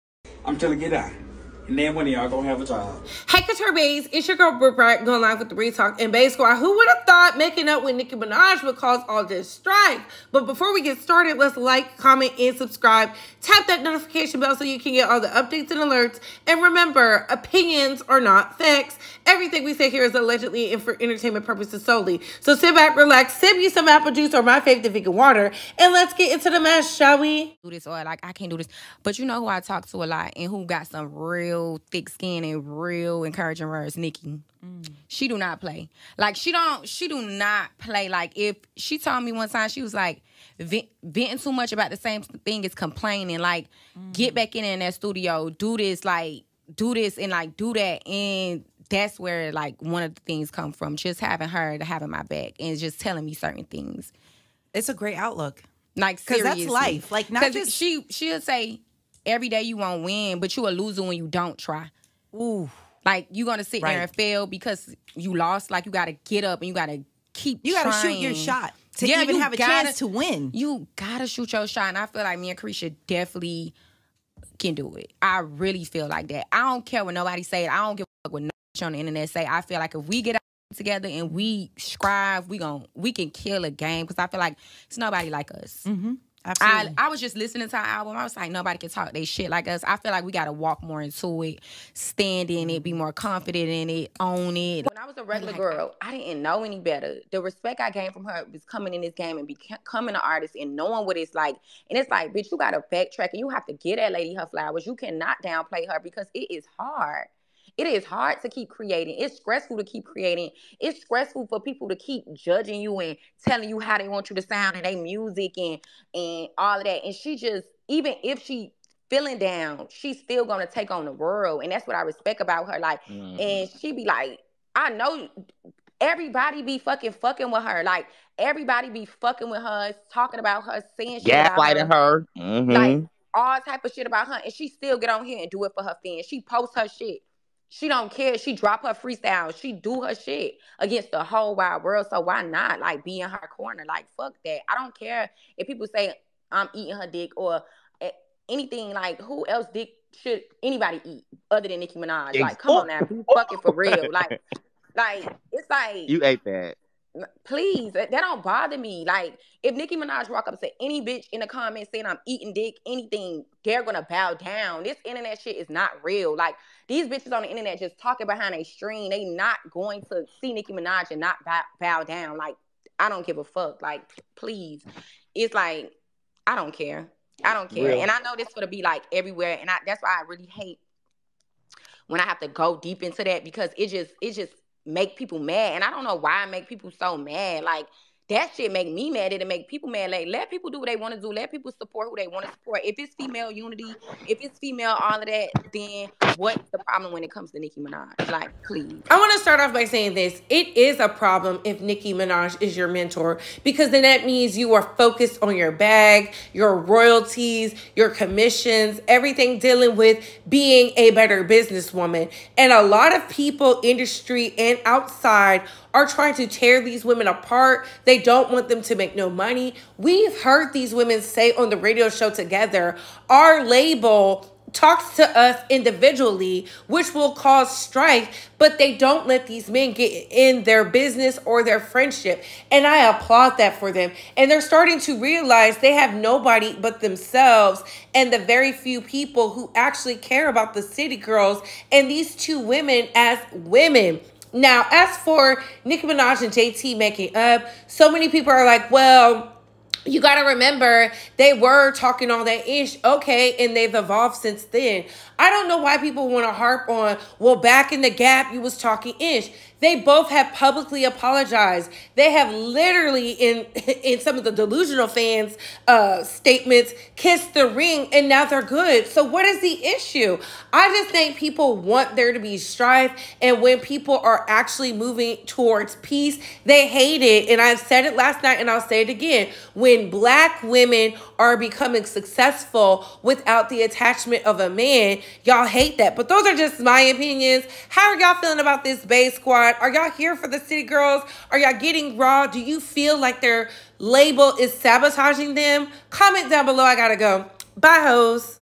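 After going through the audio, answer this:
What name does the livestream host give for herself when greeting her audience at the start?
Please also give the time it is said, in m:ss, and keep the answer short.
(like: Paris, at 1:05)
Britt Bright, at 0:04.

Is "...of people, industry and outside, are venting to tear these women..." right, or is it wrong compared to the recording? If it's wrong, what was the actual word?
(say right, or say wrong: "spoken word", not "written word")
wrong: "trying", not "venting".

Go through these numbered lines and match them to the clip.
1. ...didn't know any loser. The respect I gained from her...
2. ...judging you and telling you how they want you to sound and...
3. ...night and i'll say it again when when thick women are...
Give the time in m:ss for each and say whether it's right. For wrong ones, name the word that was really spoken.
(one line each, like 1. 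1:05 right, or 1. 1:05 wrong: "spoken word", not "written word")
1. 1:36 wrong: "better", not "loser"
2. 1:52 right
3. 4:38 wrong: "black", not "thick".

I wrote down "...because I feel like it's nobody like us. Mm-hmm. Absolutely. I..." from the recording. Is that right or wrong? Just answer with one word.
right.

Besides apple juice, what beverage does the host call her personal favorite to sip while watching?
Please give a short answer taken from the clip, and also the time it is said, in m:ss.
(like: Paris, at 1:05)
Vegan water, at 0:24.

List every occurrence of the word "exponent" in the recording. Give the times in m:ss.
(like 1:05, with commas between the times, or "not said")
not said.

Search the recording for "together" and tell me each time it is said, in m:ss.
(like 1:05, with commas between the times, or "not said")
1:20, 3:42.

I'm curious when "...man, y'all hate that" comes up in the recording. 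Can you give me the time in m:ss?
4:44.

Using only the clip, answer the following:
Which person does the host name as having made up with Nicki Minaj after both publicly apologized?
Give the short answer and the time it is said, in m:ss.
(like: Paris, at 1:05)
JT, at 4:06.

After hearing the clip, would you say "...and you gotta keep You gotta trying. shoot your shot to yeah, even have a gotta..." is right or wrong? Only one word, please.
right.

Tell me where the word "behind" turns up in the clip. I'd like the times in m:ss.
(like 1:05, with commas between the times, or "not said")
2:48.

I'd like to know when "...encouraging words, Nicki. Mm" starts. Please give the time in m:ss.
0:33.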